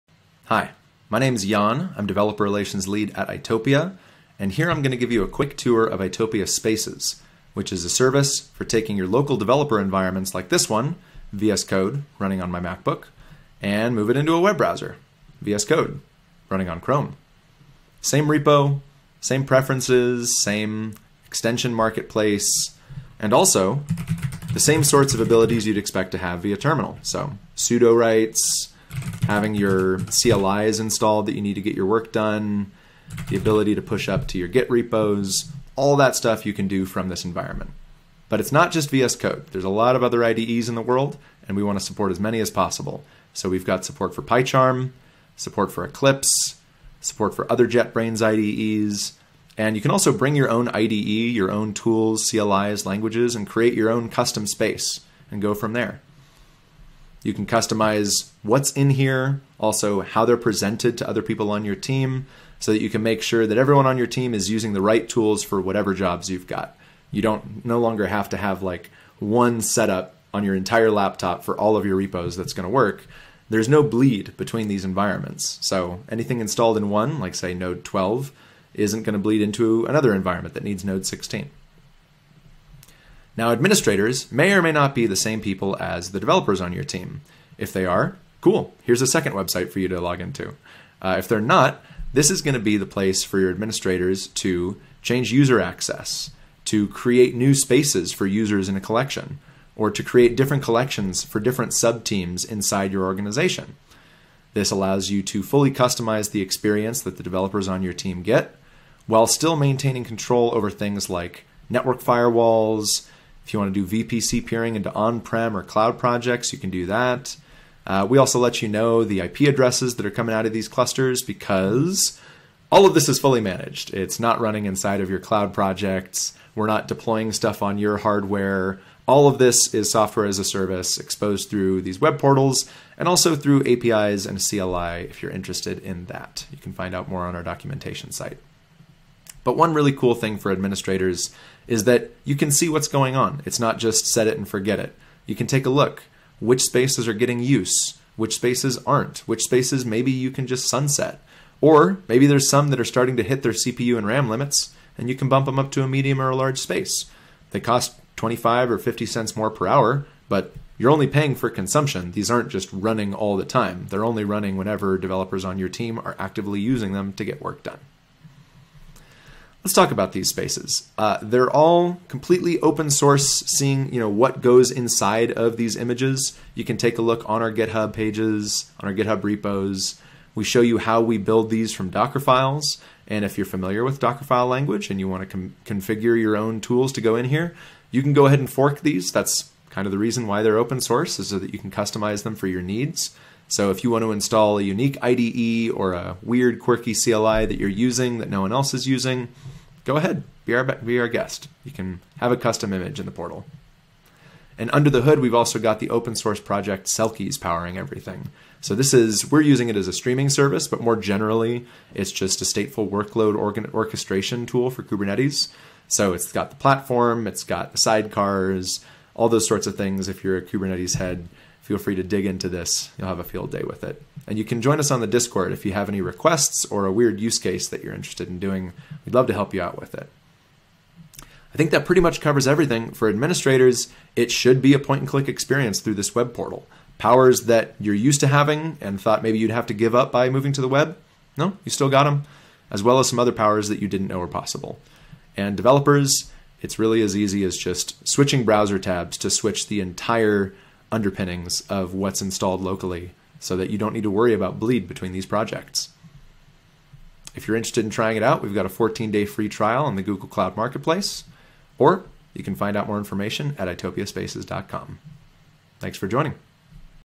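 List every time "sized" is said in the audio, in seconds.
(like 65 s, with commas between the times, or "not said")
not said.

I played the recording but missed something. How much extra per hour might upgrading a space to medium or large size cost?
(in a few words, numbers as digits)
25 or 50 cents.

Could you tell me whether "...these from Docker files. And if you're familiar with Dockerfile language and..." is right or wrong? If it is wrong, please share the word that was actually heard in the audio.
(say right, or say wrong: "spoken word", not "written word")
right.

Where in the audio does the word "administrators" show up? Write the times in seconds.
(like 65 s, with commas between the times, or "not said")
83 s, 93 s, 140 s, 233 s.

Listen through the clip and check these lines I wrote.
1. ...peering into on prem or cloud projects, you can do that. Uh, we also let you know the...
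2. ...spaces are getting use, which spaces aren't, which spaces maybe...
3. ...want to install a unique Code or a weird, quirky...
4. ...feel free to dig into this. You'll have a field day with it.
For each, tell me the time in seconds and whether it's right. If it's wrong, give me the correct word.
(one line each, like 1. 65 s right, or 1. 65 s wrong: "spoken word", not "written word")
1. 114 s right
2. 146 s right
3. 193 s wrong: "IDE", not "Code"
4. 221 s right.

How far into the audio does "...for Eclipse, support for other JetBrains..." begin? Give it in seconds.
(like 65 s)
45 s.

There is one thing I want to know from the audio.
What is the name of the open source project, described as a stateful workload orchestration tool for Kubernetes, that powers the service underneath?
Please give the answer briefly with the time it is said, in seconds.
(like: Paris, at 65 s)
Selkies, at 206 s.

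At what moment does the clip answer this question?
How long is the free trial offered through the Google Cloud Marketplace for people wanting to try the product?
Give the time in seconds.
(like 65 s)
258 s.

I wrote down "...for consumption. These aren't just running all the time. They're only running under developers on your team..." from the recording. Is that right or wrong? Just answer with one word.
wrong.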